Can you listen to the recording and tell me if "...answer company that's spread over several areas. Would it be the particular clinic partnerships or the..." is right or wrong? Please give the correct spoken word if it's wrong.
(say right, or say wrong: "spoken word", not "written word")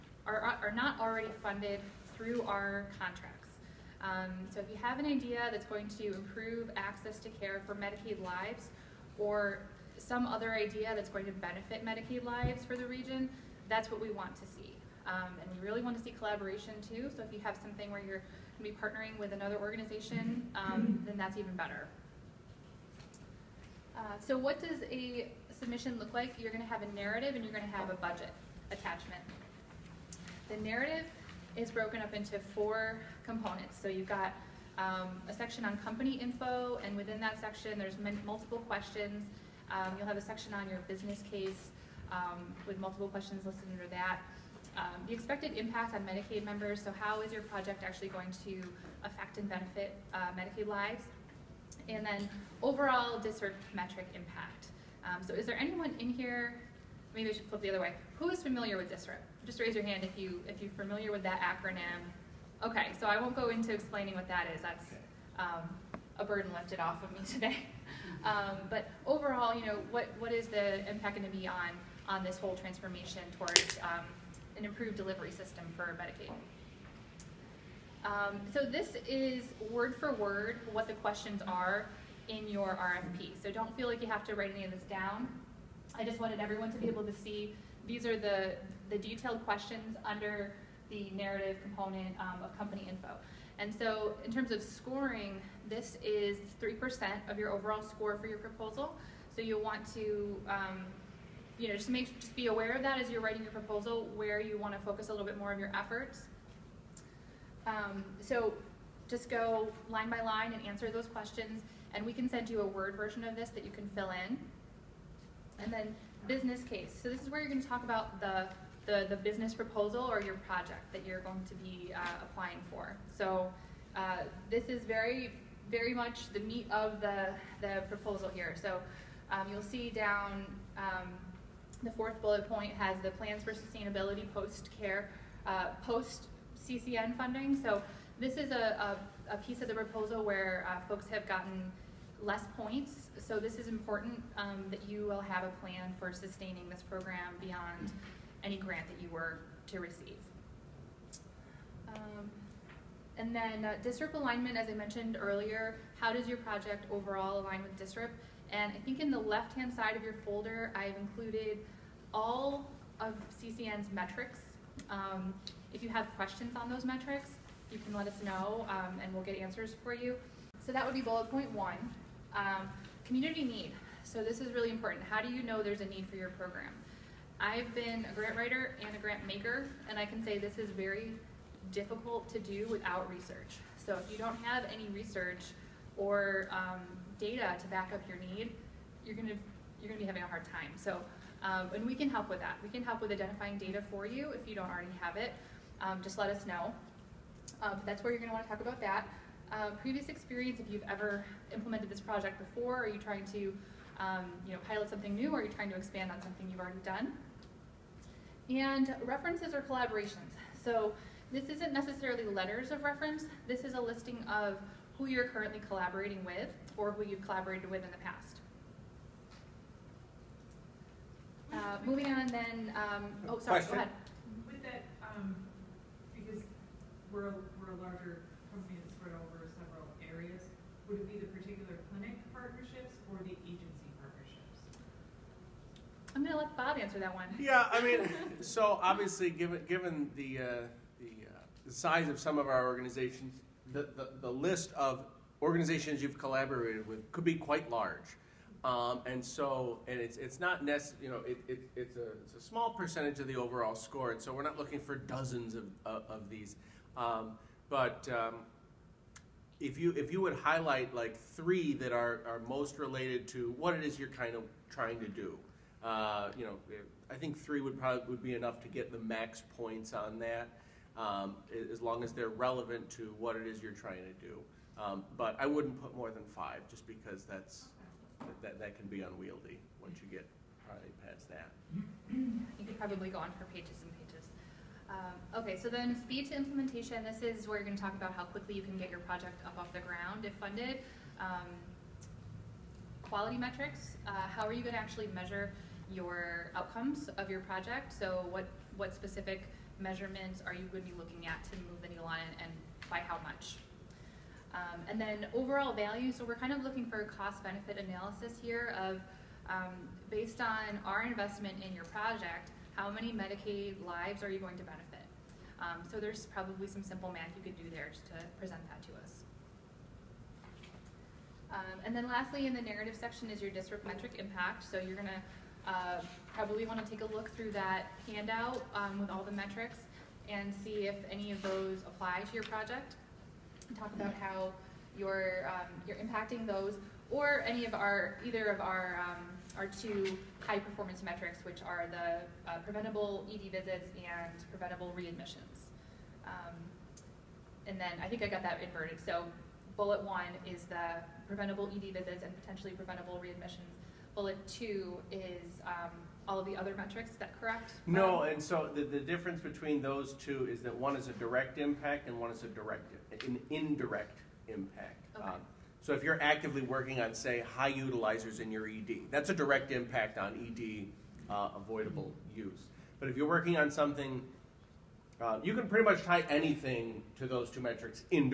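wrong: "larger", not "answer".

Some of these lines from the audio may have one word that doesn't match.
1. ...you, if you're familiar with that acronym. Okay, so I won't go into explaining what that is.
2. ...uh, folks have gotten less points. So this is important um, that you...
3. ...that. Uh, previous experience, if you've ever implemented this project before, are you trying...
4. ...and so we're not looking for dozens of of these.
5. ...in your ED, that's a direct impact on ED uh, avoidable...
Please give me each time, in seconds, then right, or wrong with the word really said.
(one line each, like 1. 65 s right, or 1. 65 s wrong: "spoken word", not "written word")
1. 60 s right
2. 140 s right
3. 198 s right
4. 254 s right
5. 368 s right.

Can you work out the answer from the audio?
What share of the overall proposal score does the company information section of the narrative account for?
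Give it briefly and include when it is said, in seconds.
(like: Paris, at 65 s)
3%, at 96 s.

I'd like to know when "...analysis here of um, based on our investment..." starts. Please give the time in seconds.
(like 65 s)
307 s.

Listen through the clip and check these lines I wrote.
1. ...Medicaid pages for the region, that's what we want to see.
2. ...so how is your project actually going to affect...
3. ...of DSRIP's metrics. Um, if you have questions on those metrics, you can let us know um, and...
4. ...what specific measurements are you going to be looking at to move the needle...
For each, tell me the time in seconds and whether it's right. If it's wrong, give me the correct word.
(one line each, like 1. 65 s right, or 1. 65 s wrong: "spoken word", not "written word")
1. 11 s wrong: "lives", not "pages"
2. 46 s right
3. 163 s wrong: "CCN", not "DSRIP"
4. 298 s right.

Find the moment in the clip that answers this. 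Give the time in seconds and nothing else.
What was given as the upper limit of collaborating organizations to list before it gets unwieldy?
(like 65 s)
276 s.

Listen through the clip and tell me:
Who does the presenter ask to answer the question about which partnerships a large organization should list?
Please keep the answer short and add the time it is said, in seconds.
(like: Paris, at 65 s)
Bob, at 236 s.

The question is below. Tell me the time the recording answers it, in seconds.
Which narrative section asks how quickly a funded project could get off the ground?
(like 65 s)
286 s.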